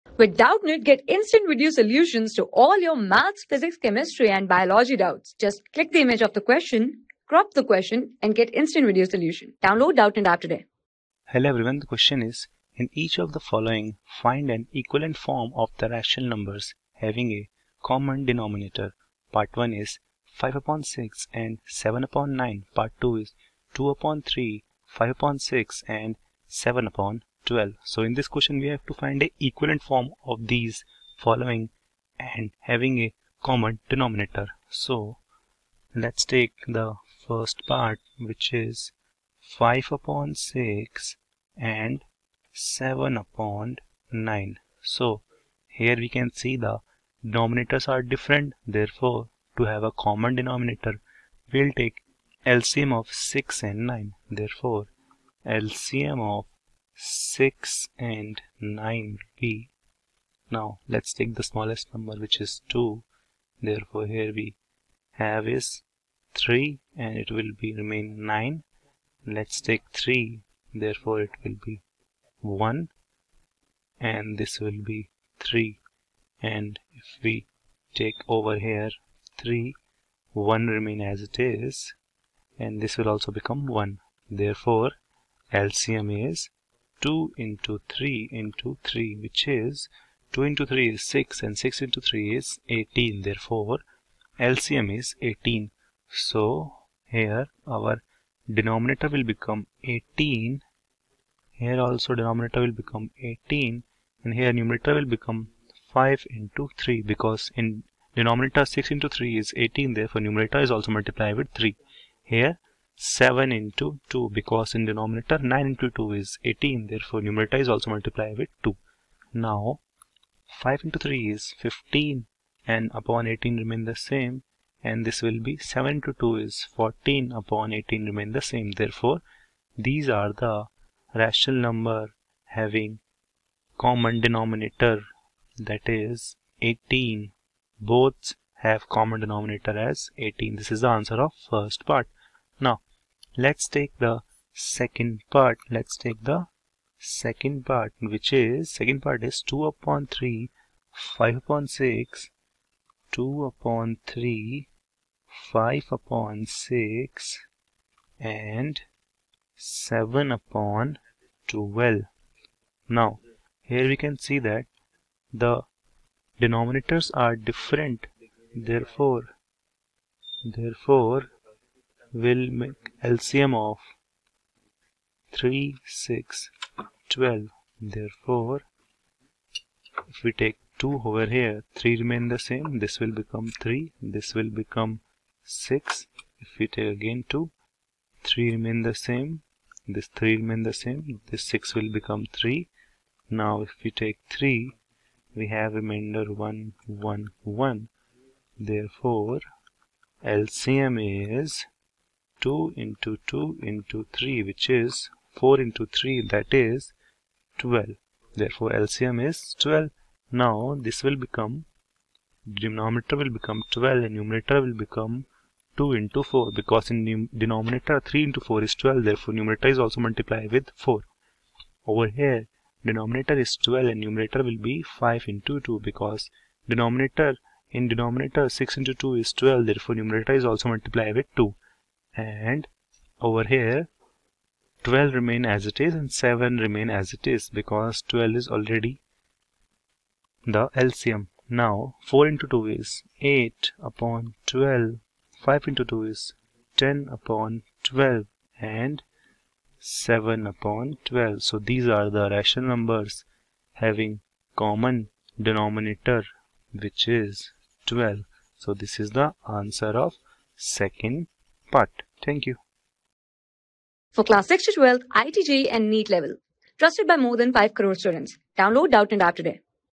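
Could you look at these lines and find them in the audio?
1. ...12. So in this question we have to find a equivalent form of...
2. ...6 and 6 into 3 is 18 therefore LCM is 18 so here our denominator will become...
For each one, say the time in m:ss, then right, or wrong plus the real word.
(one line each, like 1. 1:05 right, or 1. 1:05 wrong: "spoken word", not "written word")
1. 0:27 right
2. 1:31 right.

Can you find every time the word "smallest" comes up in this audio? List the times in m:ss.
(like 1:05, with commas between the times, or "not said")
1:01.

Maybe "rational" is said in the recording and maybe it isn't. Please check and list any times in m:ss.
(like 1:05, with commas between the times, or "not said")
0:15, 2:11, 4:12.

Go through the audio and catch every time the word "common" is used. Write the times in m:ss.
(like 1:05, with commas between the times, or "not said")
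0:17, 0:33, 0:49, 2:13, 2:18, 4:14.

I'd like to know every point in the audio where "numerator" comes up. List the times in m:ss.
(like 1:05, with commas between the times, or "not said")
1:44, 1:50, 1:57, 3:34, 3:39, 3:44, 3:50.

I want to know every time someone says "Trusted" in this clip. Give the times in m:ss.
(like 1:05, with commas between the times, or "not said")
4:26.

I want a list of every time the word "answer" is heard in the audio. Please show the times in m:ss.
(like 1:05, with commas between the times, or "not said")
2:20, 4:19.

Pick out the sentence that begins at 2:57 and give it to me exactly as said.
Therefore, if we take 2 over here, 3 remain the same.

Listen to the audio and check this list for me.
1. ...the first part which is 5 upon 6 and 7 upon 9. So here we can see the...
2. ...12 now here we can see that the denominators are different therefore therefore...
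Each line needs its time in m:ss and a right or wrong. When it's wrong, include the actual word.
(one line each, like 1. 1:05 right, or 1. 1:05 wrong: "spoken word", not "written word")
1. 0:36 right
2. 2:41 right.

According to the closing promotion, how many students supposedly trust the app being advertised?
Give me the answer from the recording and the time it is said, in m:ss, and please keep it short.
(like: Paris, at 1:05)
more than 5 crore, at 4:27.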